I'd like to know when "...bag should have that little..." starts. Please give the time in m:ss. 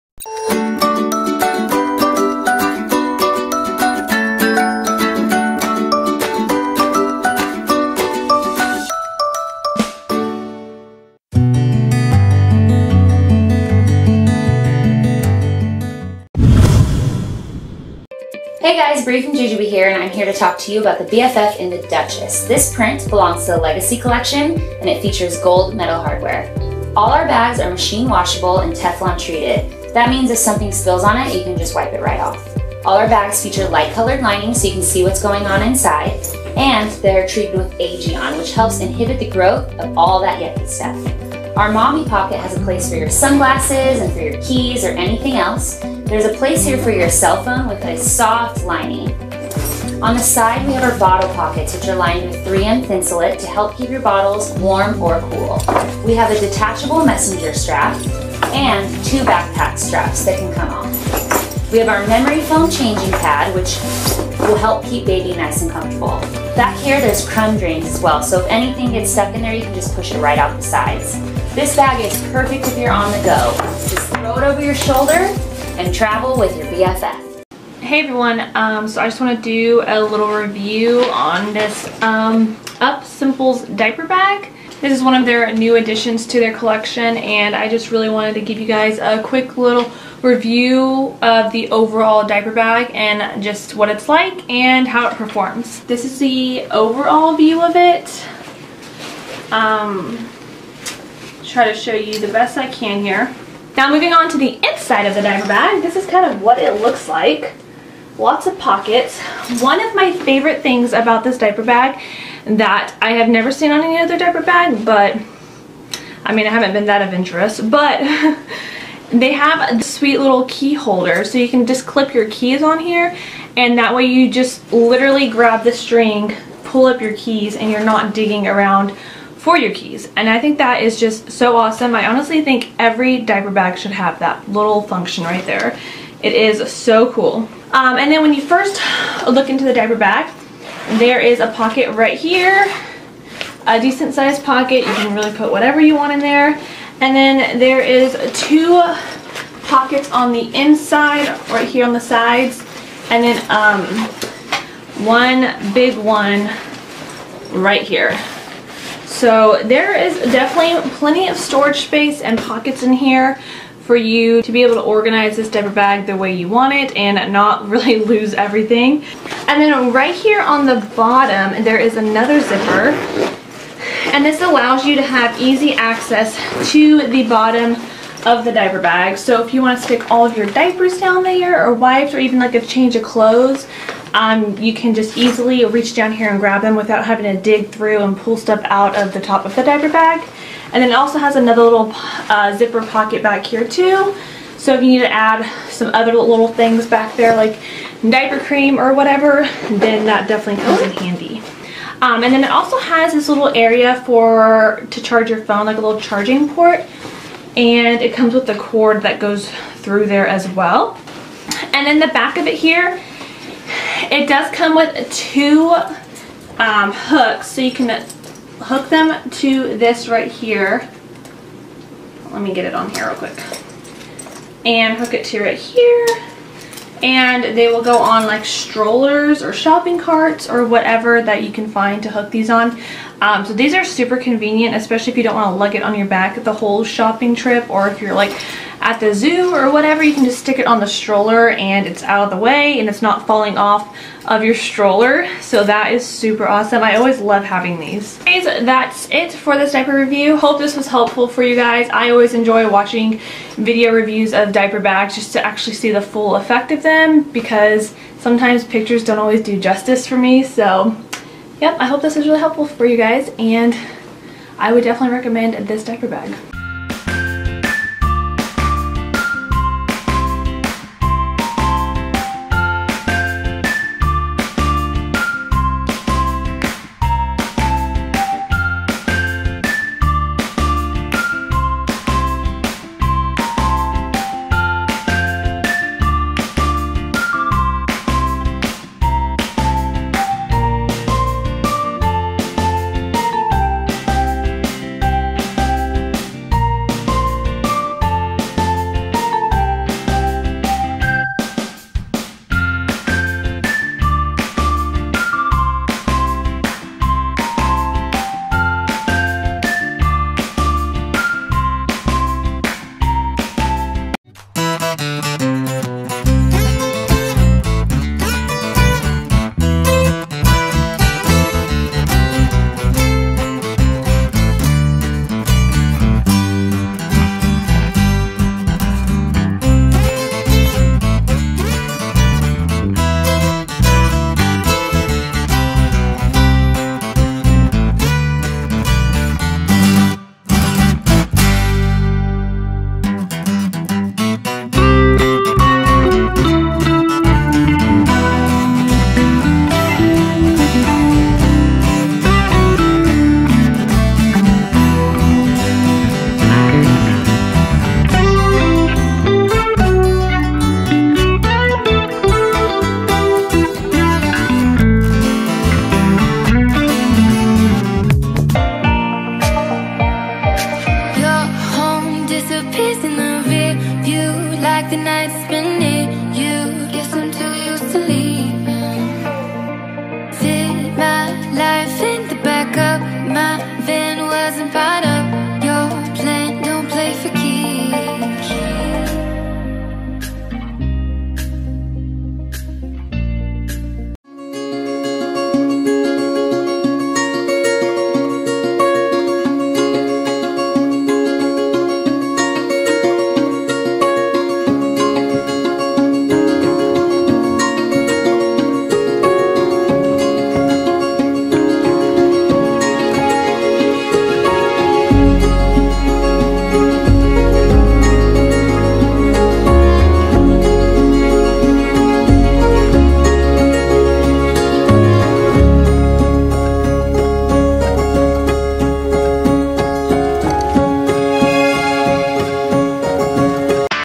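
2:13.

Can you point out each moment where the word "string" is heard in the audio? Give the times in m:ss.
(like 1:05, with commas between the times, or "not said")
2:05.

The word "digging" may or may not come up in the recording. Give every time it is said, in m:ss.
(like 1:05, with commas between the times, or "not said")
2:08.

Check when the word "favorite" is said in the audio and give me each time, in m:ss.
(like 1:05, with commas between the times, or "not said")
1:50.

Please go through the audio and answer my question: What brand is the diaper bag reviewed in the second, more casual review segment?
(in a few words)
Upsimples.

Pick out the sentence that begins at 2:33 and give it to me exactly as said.
And then um, one big one right here.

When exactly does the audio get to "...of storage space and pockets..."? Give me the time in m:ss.
2:41.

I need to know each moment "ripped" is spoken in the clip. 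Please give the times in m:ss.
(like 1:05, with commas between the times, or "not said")
not said.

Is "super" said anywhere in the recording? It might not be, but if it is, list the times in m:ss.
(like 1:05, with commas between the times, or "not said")
3:53, 4:06.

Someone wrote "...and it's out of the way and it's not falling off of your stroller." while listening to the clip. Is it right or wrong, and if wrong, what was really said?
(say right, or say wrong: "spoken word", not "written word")
right.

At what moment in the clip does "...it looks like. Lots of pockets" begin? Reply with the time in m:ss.
1:46.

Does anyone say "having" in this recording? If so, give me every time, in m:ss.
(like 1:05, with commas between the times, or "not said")
3:07, 4:07.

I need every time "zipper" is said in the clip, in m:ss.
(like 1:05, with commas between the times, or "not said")
2:52, 3:12.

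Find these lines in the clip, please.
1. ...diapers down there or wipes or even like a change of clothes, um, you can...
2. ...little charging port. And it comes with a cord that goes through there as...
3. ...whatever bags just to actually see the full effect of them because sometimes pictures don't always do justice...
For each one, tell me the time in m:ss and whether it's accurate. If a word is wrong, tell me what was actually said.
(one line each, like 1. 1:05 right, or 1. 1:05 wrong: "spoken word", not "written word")
1. 3:00 right
2. 3:25 right
3. 4:14 wrong: "diaper", not "whatever".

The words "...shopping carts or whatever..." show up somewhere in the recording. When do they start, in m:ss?
3:49.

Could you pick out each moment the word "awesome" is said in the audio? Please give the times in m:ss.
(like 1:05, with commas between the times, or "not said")
2:11, 4:06.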